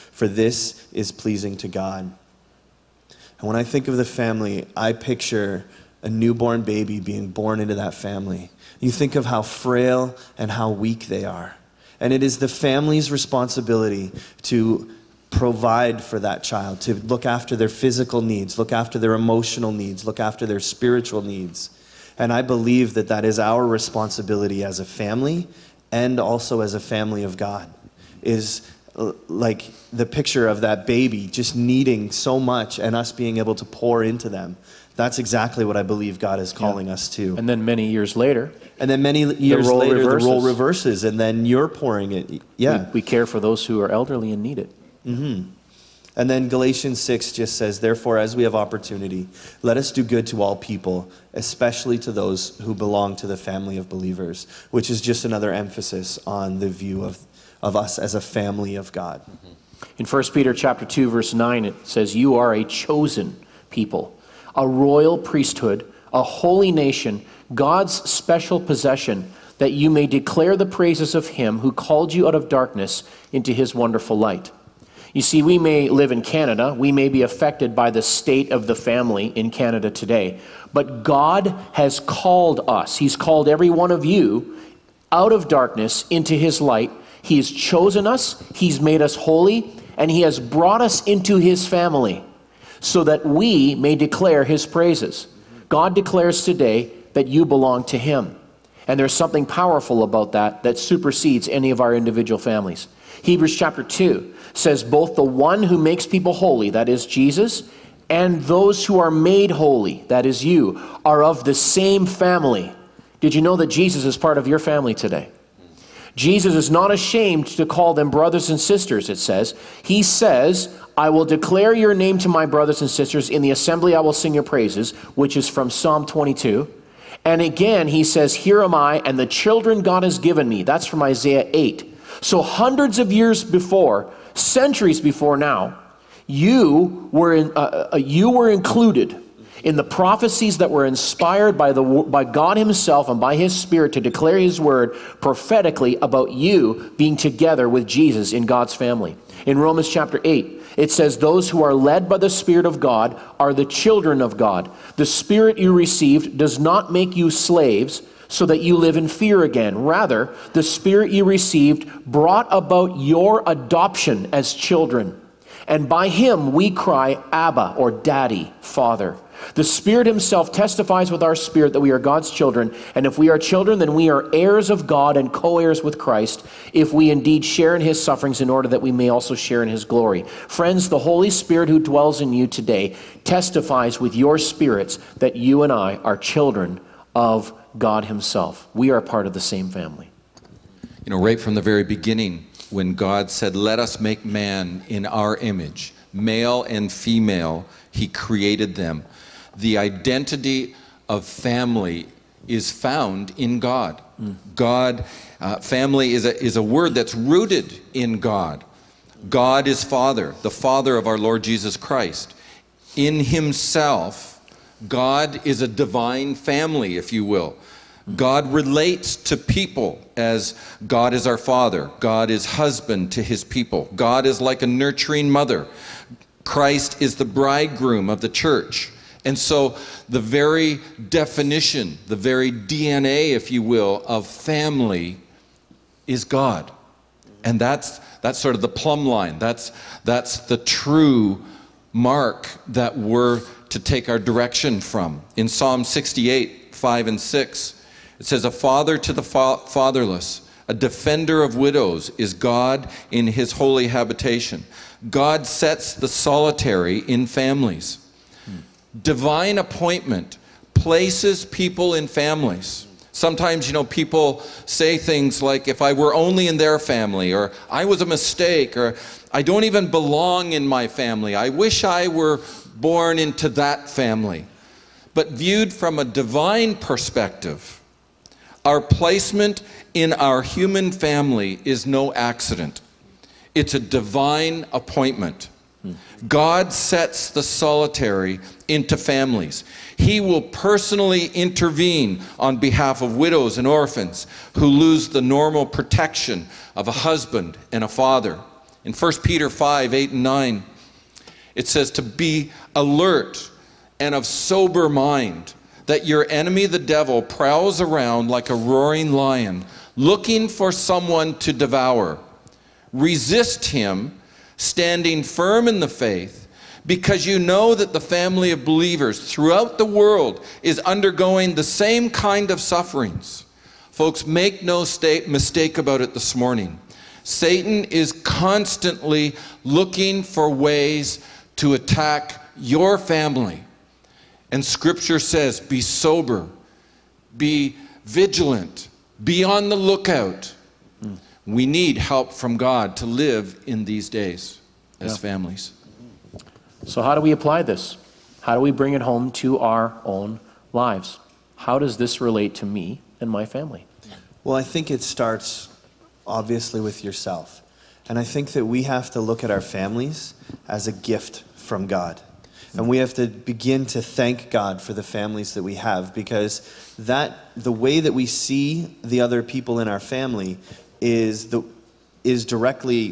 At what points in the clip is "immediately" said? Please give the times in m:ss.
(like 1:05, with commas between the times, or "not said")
not said.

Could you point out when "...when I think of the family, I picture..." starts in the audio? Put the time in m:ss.
0:03.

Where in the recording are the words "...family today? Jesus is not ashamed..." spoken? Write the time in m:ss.
1:54.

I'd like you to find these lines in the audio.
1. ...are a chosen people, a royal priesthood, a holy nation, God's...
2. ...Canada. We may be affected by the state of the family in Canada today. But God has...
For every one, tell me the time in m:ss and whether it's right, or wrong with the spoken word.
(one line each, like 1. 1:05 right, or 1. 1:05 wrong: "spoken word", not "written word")
1. 1:02 right
2. 1:16 right.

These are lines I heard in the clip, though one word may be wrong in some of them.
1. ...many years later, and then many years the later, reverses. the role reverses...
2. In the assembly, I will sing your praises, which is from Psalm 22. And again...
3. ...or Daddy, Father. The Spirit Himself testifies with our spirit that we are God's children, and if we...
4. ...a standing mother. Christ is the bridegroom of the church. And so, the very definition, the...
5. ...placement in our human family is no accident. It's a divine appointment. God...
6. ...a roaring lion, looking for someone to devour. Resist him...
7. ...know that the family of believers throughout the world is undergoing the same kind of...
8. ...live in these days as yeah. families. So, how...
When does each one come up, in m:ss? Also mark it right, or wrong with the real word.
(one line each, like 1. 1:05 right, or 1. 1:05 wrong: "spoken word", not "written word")
1. 0:37 right
2. 2:03 right
3. 2:47 right
4. 3:44 wrong: "nurturing", not "standing"
5. 4:38 right
6. 5:08 right
7. 5:17 right
8. 5:43 right.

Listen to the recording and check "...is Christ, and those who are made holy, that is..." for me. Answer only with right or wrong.
wrong.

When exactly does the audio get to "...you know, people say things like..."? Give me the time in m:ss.
4:23.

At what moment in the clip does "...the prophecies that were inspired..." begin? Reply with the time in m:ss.
2:19.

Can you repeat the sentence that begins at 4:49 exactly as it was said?
He will personally intervene on behalf of widows and orphans who lose the normal protection of a husband and a father.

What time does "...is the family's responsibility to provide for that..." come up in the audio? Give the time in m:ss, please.
0:12.